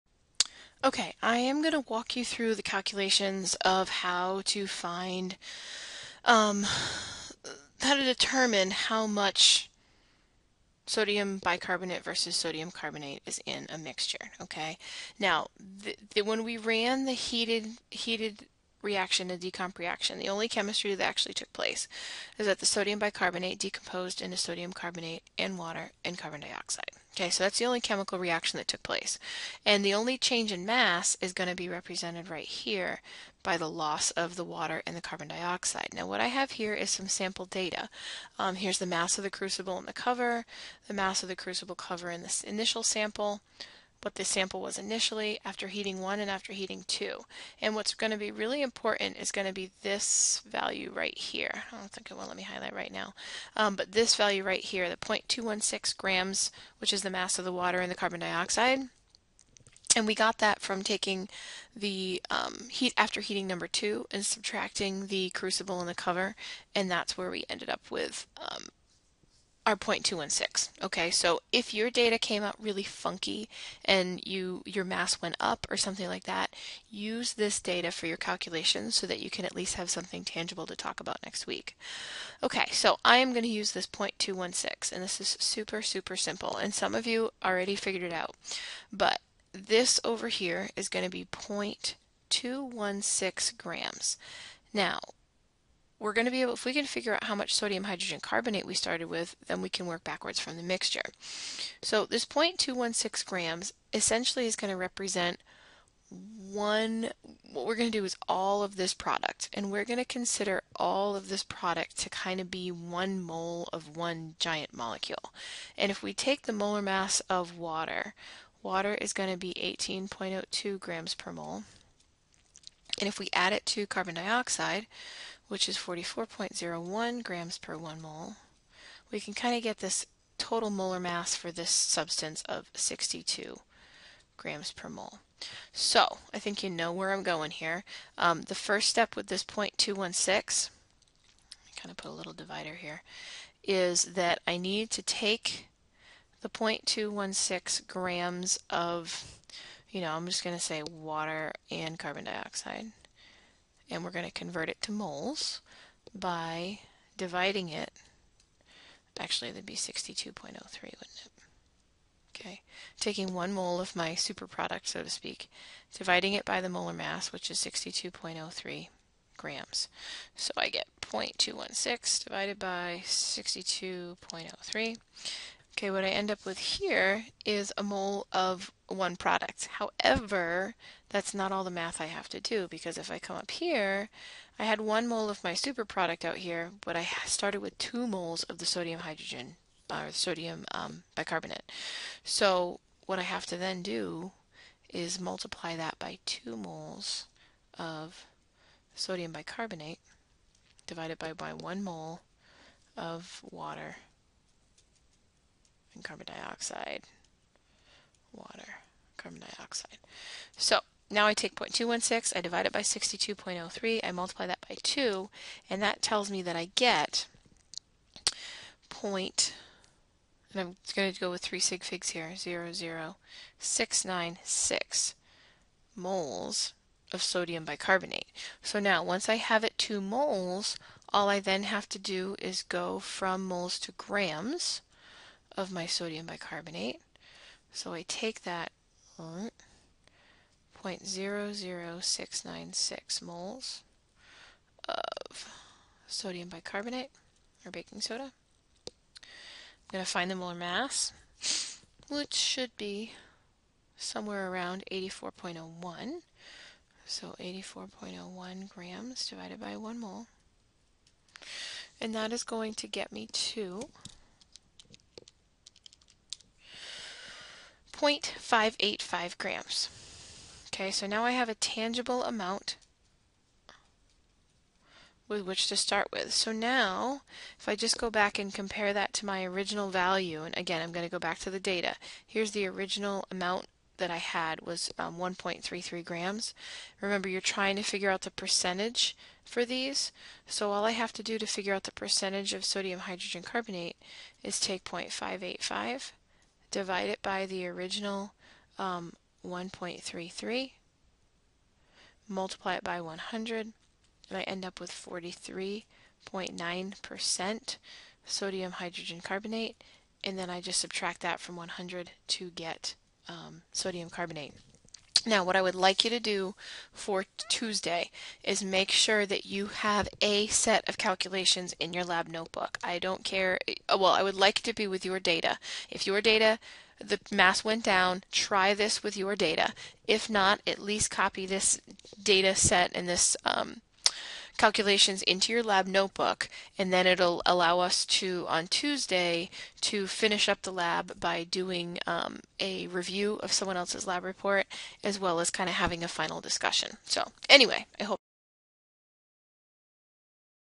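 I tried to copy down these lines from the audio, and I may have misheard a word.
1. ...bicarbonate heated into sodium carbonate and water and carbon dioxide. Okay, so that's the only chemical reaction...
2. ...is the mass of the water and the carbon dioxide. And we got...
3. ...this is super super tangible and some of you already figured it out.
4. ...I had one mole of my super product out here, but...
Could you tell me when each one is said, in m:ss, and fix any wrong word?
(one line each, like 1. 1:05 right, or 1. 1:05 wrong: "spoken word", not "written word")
1. 0:22 wrong: "decomposed", not "heated"
2. 0:56 right
3. 1:25 wrong: "simple", not "tangible"
4. 3:04 right.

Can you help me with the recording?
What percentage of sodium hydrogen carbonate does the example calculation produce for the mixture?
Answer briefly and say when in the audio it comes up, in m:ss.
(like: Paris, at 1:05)
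43.9%, at 5:04.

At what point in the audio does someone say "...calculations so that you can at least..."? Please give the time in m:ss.
1:18.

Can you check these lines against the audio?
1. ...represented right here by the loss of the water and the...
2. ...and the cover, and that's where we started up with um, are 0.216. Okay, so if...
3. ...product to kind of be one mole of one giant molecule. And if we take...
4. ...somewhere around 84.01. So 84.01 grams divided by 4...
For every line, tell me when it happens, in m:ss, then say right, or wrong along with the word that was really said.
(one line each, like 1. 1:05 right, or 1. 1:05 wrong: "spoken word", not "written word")
1. 0:31 right
2. 1:05 wrong: "ended", not "started"
3. 1:51 right
4. 4:13 wrong: "1", not "4".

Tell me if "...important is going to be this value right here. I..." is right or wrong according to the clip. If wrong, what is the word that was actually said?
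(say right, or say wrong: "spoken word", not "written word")
right.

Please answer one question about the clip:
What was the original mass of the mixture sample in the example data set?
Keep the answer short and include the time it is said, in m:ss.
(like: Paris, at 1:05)
1.33 grams, at 4:45.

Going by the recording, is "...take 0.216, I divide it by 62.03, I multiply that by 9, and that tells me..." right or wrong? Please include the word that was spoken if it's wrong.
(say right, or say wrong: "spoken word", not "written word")
wrong: "2", not "9".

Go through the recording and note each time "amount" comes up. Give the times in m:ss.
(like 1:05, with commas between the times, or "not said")
4:32, 4:43.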